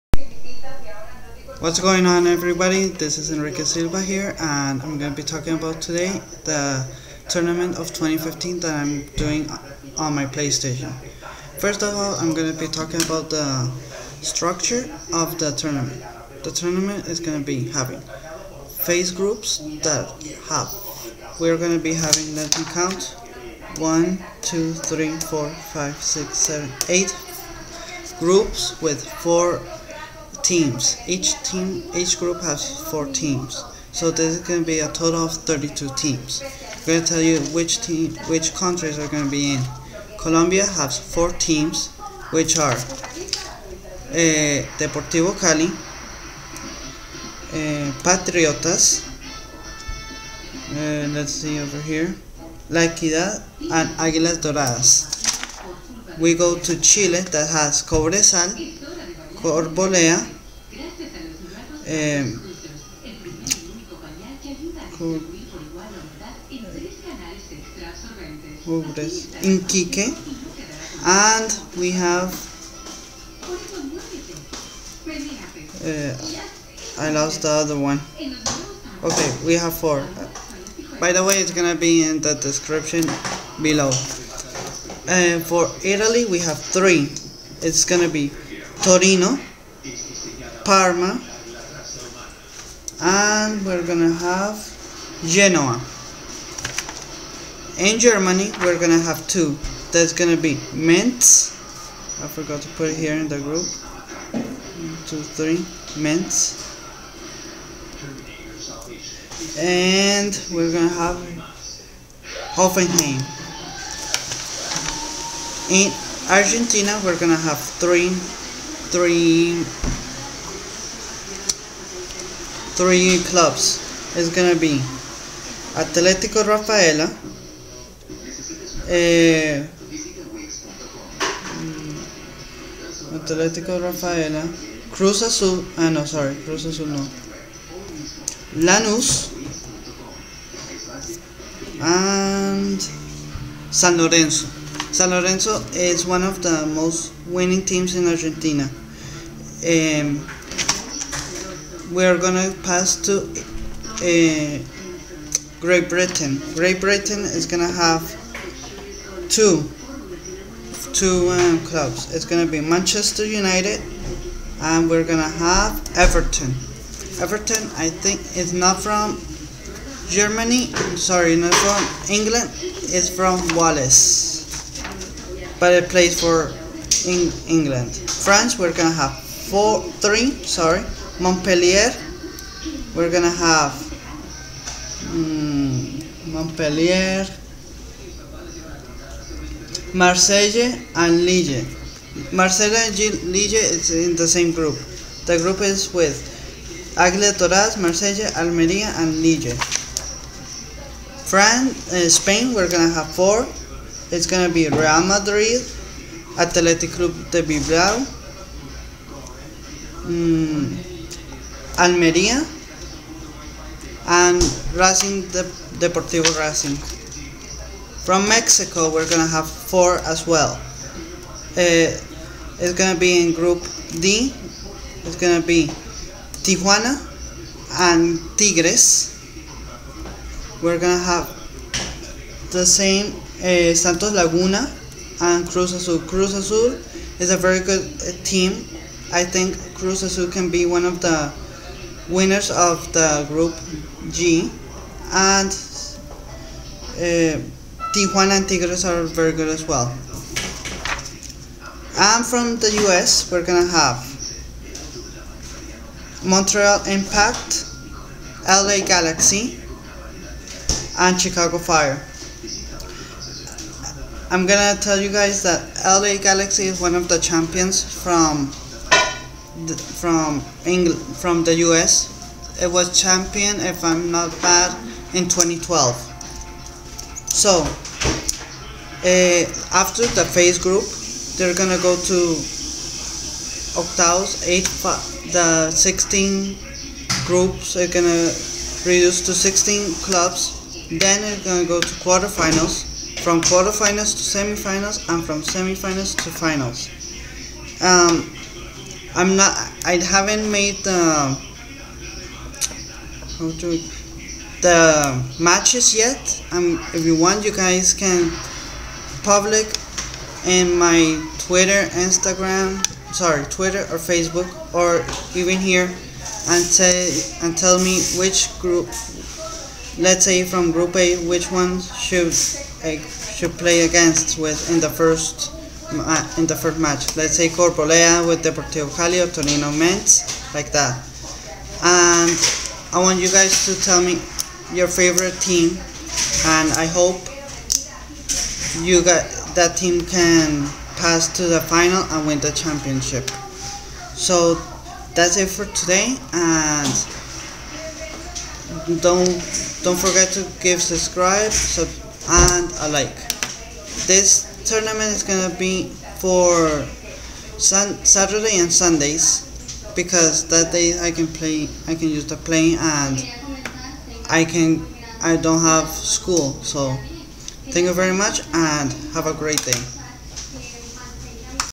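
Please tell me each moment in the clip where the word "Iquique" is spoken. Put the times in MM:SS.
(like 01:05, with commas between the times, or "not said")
01:09.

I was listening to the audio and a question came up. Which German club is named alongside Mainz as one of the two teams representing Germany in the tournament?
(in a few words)
Hoffenheim.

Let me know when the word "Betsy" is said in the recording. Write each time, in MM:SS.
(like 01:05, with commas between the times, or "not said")
not said.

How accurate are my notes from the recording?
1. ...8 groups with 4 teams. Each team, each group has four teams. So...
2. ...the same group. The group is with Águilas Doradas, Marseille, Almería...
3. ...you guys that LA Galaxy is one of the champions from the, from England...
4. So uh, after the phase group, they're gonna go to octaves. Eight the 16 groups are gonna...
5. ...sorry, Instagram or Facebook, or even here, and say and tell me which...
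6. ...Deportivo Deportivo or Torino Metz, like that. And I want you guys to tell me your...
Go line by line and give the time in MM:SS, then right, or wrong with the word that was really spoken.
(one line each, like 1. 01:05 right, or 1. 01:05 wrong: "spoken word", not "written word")
1. 00:26 right
2. 03:14 right
3. 04:24 right
4. 04:37 right
5. 05:13 wrong: "Twitter", not "Instagram"
6. 05:28 wrong: "Cali", not "Deportivo".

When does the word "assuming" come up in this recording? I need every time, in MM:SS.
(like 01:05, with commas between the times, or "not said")
not said.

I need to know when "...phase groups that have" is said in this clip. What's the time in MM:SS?
00:18.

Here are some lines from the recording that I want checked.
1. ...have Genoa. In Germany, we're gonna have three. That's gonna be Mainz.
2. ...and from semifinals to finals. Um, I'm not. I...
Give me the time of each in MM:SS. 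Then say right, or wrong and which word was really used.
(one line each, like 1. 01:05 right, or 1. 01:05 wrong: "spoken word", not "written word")
1. 01:34 wrong: "two", not "three"
2. 04:55 right.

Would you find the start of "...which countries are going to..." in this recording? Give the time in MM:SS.
00:38.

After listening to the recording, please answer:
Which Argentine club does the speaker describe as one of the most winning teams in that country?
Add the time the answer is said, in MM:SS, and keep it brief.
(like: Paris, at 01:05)
San Lorenzo, at 02:24.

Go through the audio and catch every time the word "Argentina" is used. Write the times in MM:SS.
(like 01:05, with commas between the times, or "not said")
01:56, 02:28.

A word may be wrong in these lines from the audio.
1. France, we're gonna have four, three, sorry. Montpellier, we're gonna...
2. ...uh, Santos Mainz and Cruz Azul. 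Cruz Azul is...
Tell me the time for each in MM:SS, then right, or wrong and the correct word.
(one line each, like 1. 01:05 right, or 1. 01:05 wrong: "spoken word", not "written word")
1. 02:58 right
2. 03:53 wrong: "Laguna", not "Mainz".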